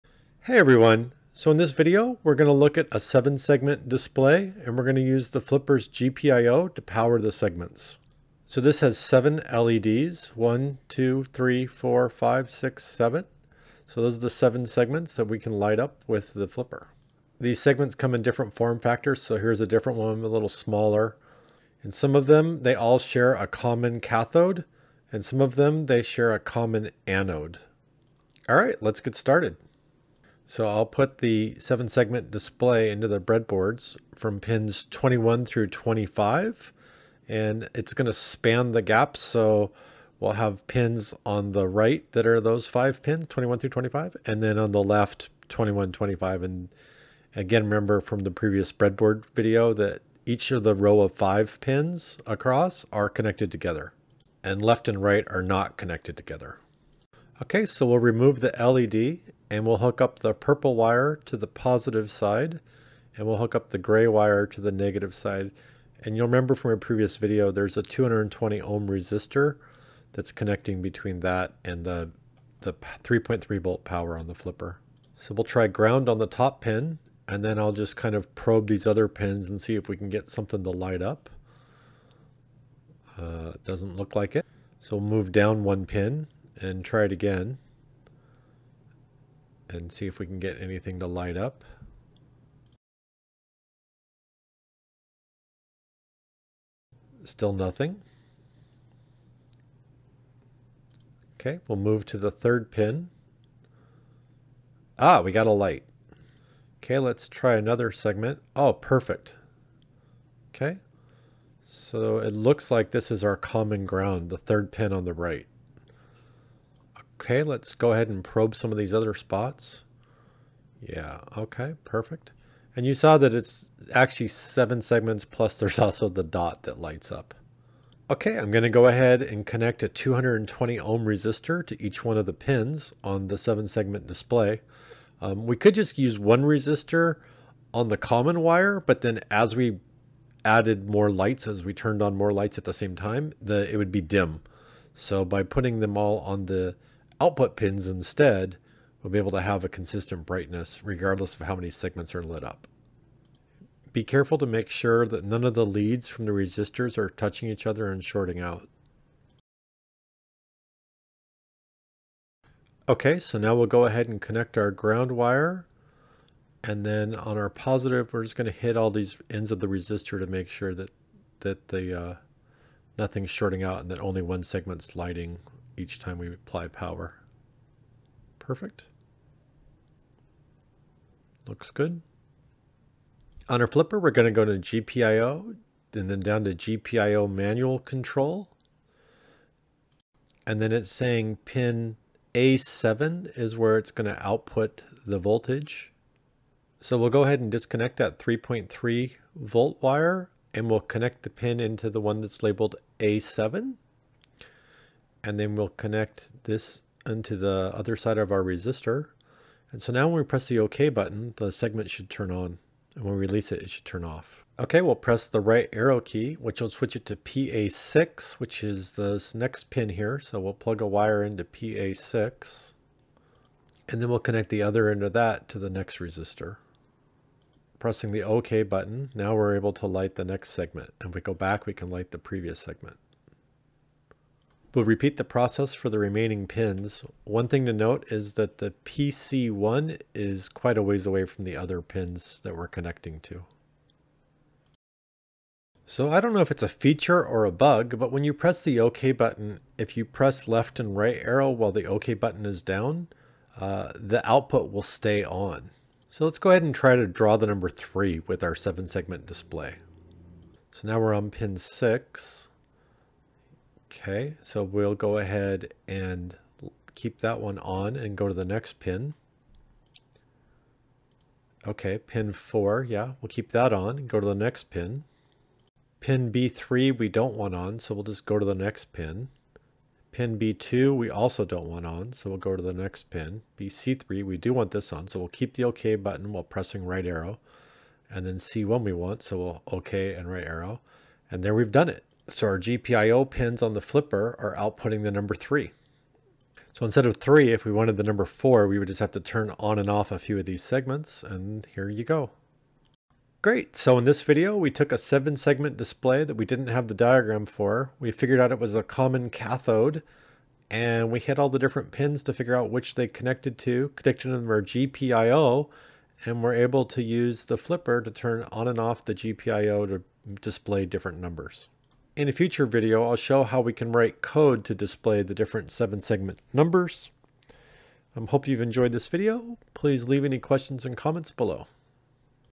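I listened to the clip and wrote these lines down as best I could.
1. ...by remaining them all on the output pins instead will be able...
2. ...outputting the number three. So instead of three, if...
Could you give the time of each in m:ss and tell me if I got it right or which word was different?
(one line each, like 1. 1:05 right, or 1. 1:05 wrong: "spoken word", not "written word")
1. 2:25 wrong: "putting", not "remaining"
2. 4:54 right.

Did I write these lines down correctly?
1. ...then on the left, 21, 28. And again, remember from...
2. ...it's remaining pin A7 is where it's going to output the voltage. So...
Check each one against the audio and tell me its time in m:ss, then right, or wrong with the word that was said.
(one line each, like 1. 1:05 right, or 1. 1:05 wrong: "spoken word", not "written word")
1. 0:44 wrong: "25", not "28"
2. 3:10 wrong: "saying", not "remaining".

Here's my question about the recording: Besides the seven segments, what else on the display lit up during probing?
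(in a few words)
The dot.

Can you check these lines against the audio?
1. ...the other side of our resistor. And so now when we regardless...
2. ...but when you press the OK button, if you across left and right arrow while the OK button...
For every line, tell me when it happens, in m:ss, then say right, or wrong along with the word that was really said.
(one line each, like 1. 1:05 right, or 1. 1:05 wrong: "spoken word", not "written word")
1. 3:27 wrong: "press", not "regardless"
2. 4:07 wrong: "press", not "across".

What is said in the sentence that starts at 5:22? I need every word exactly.
In a future video, I'll show how we can write code to display the different seven segment numbers.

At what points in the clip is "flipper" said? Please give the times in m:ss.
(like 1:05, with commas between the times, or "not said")
0:05, 0:16, 1:14, 3:03, 4:53, 5:17.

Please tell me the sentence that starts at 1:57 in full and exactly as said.
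Okay, let's go ahead and probe some of these other spots.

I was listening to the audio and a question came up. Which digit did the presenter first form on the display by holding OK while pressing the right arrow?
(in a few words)
3.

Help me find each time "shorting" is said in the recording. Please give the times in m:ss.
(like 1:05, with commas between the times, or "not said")
2:38, 2:53.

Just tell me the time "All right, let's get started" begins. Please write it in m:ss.
0:28.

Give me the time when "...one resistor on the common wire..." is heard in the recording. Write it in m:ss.
2:16.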